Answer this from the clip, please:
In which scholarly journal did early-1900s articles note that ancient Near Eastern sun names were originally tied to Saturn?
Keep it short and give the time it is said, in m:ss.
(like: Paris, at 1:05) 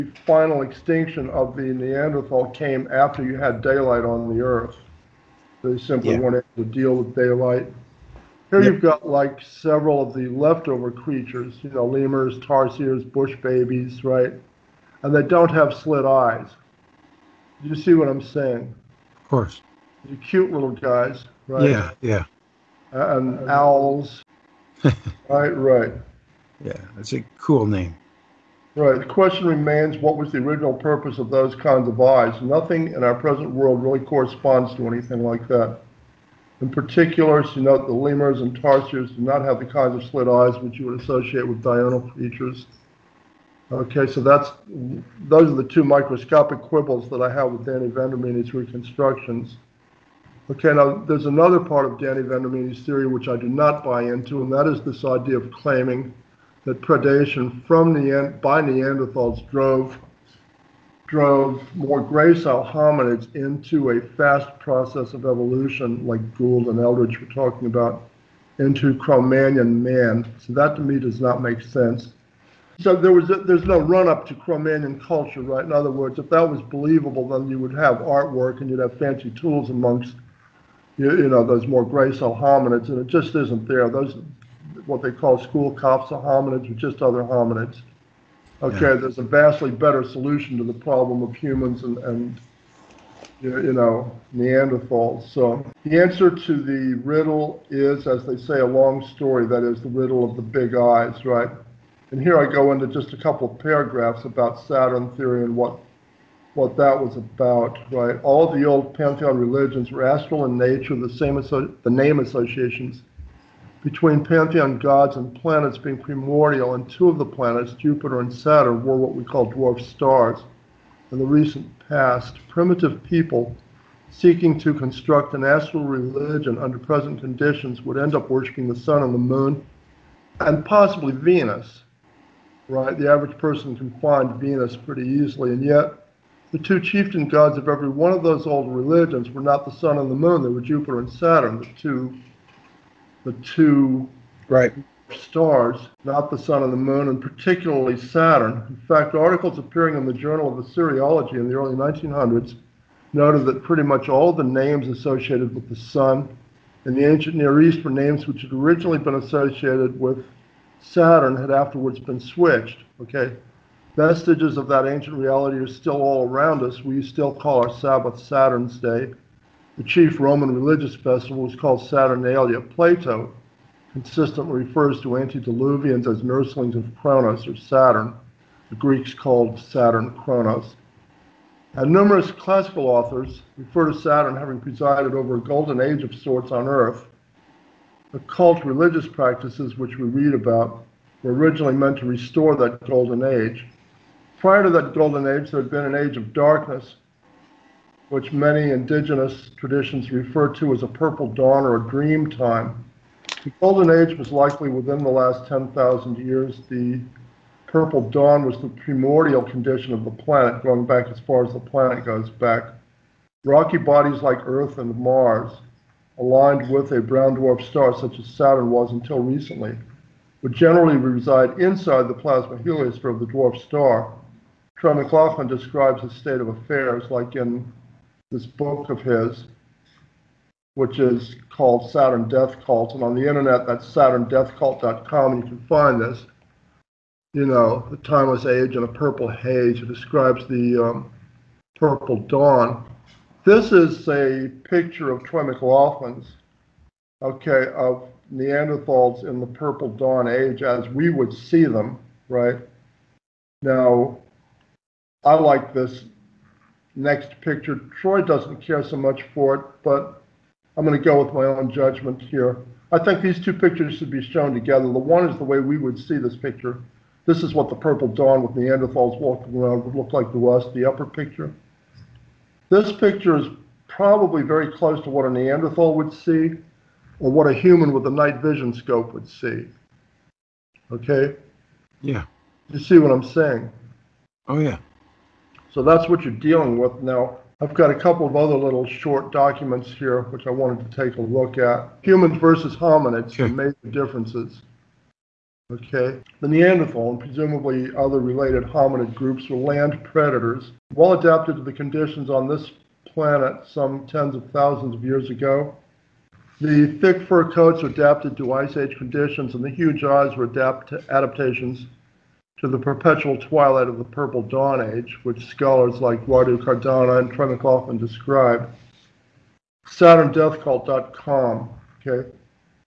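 Journal of Assyriology, at 2:30.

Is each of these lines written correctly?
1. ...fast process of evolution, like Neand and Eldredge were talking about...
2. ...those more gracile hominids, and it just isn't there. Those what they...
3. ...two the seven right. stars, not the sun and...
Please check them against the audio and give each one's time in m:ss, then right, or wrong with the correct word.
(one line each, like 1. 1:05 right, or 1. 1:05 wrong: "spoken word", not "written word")
1. 1:03 wrong: "Gould", not "Neand"
2. 1:21 right
3. 2:21 wrong: "two", not "seven".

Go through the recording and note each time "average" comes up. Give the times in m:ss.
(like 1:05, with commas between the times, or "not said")
2:13.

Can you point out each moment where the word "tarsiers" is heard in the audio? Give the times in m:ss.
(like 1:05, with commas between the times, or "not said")
0:12, 0:38.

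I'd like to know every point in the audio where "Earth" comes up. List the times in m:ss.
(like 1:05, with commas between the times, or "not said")
0:04, 3:06, 3:34.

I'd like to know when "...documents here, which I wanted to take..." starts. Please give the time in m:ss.
4:49.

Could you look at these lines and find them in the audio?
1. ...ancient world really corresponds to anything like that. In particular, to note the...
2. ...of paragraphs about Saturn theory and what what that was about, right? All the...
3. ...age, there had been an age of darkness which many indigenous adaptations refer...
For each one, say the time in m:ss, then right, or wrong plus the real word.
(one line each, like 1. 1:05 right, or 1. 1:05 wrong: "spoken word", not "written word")
1. 0:33 wrong: "present", not "ancient"
2. 1:43 right
3. 3:15 wrong: "traditions", not "adaptations".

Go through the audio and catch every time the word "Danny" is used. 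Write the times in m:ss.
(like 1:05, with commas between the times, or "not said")
0:47, 0:51.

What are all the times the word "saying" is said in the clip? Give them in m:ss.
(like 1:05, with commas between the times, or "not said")
0:18, 4:43.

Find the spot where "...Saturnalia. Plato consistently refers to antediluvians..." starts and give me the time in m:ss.
2:51.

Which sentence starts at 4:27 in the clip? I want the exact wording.
This is what the purple dawn with Neanderthals walking around would look like to us, the upper picture.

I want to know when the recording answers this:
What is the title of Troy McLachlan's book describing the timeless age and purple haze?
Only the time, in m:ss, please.
3:51.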